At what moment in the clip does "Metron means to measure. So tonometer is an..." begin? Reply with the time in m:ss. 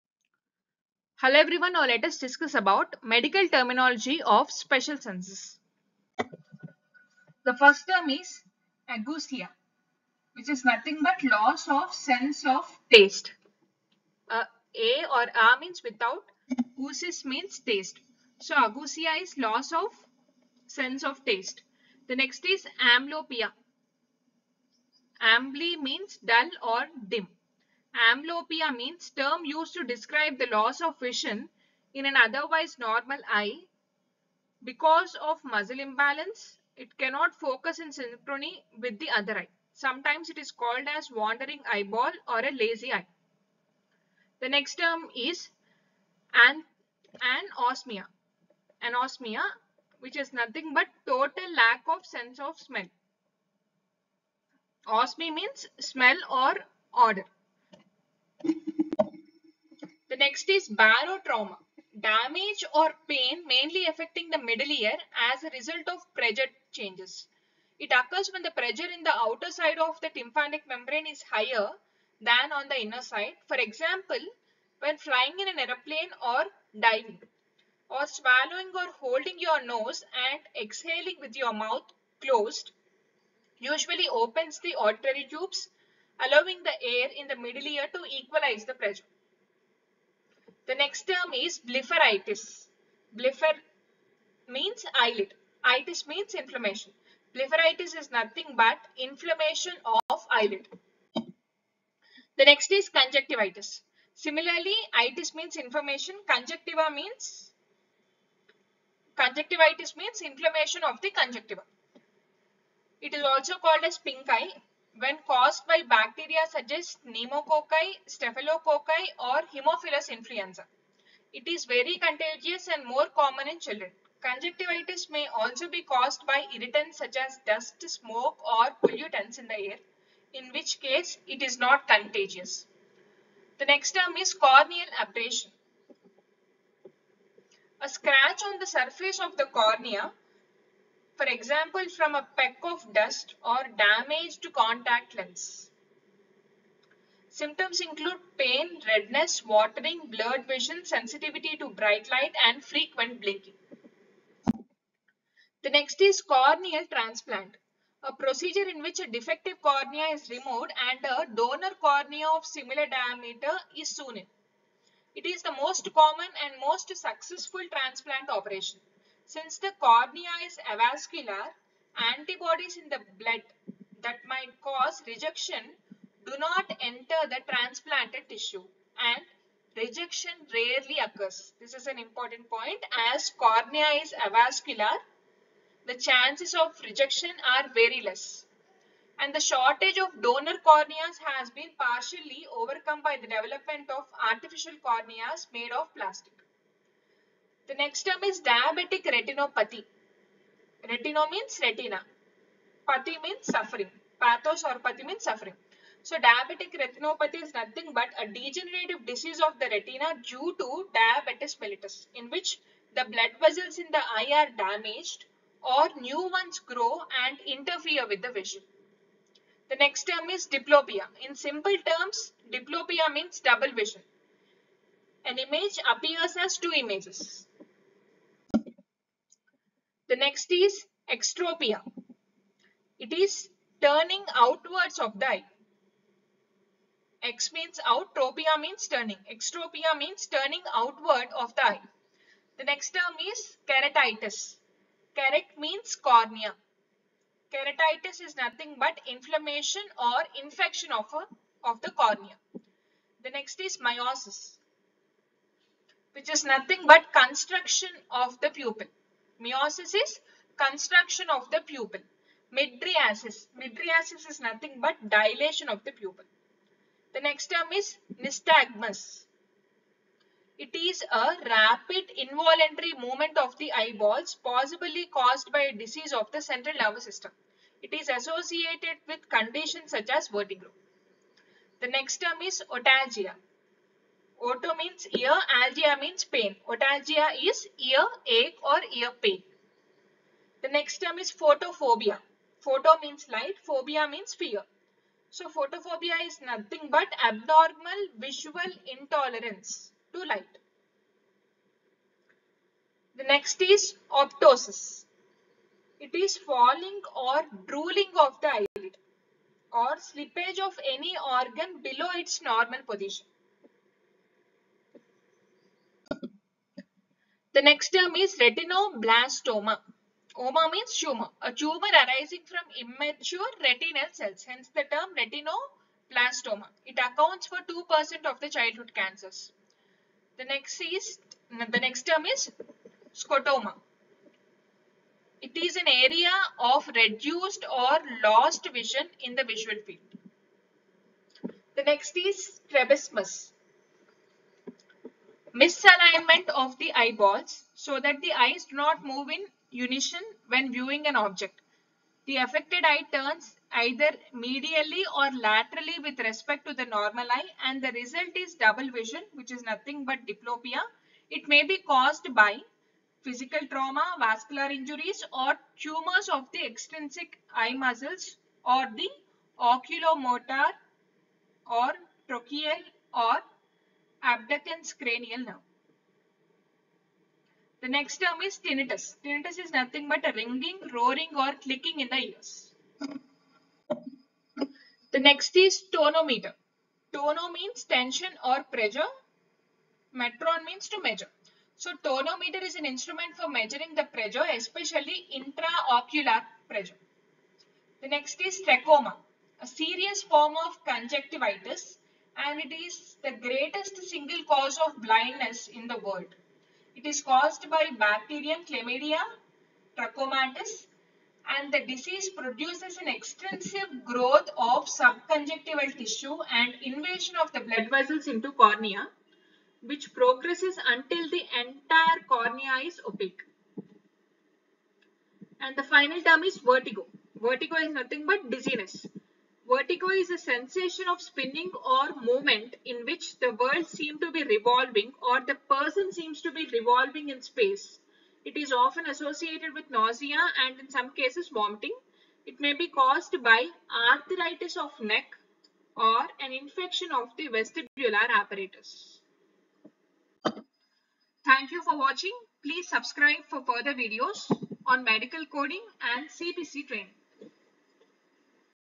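6:30.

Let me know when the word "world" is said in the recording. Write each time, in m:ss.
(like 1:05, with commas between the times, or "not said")
6:46, 7:13.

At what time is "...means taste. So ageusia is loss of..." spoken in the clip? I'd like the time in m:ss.
0:17.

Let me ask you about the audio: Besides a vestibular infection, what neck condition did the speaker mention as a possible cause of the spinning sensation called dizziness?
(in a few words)
arthritis.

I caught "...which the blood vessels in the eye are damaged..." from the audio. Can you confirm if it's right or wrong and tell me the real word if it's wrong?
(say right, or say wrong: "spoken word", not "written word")
right.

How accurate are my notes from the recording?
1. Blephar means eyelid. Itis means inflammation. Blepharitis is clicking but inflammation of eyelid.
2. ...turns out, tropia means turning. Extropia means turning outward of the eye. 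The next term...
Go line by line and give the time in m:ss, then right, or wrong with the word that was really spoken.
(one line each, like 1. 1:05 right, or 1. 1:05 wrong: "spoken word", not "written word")
1. 1:33 wrong: "nothing", not "clicking"
2. 3:57 wrong: "means", not "turns".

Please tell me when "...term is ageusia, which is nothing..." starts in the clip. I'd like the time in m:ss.
0:07.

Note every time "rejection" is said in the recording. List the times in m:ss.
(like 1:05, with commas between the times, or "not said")
2:55, 2:59, 3:06.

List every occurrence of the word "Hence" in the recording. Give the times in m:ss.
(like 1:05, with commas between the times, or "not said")
5:24.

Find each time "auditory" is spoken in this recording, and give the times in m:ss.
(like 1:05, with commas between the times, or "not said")
1:24.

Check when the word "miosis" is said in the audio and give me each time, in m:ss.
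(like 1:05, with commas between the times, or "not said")
4:13, 4:19.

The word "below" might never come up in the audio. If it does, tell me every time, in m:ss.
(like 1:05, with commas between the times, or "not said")
5:11.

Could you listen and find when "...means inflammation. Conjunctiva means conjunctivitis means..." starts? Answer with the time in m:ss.
1:45.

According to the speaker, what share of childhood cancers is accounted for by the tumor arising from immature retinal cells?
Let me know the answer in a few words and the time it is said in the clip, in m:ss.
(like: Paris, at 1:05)
2%, at 5:27.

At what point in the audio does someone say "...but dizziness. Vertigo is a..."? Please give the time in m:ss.
7:08.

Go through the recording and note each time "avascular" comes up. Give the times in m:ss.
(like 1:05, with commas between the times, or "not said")
2:50, 3:04.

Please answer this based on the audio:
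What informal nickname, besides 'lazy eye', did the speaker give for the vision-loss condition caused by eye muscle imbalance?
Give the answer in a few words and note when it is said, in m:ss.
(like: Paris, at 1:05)
wandering eyeball, at 0:41.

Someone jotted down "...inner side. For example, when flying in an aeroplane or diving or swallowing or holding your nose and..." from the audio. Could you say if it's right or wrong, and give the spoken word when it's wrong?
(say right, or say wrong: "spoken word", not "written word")
right.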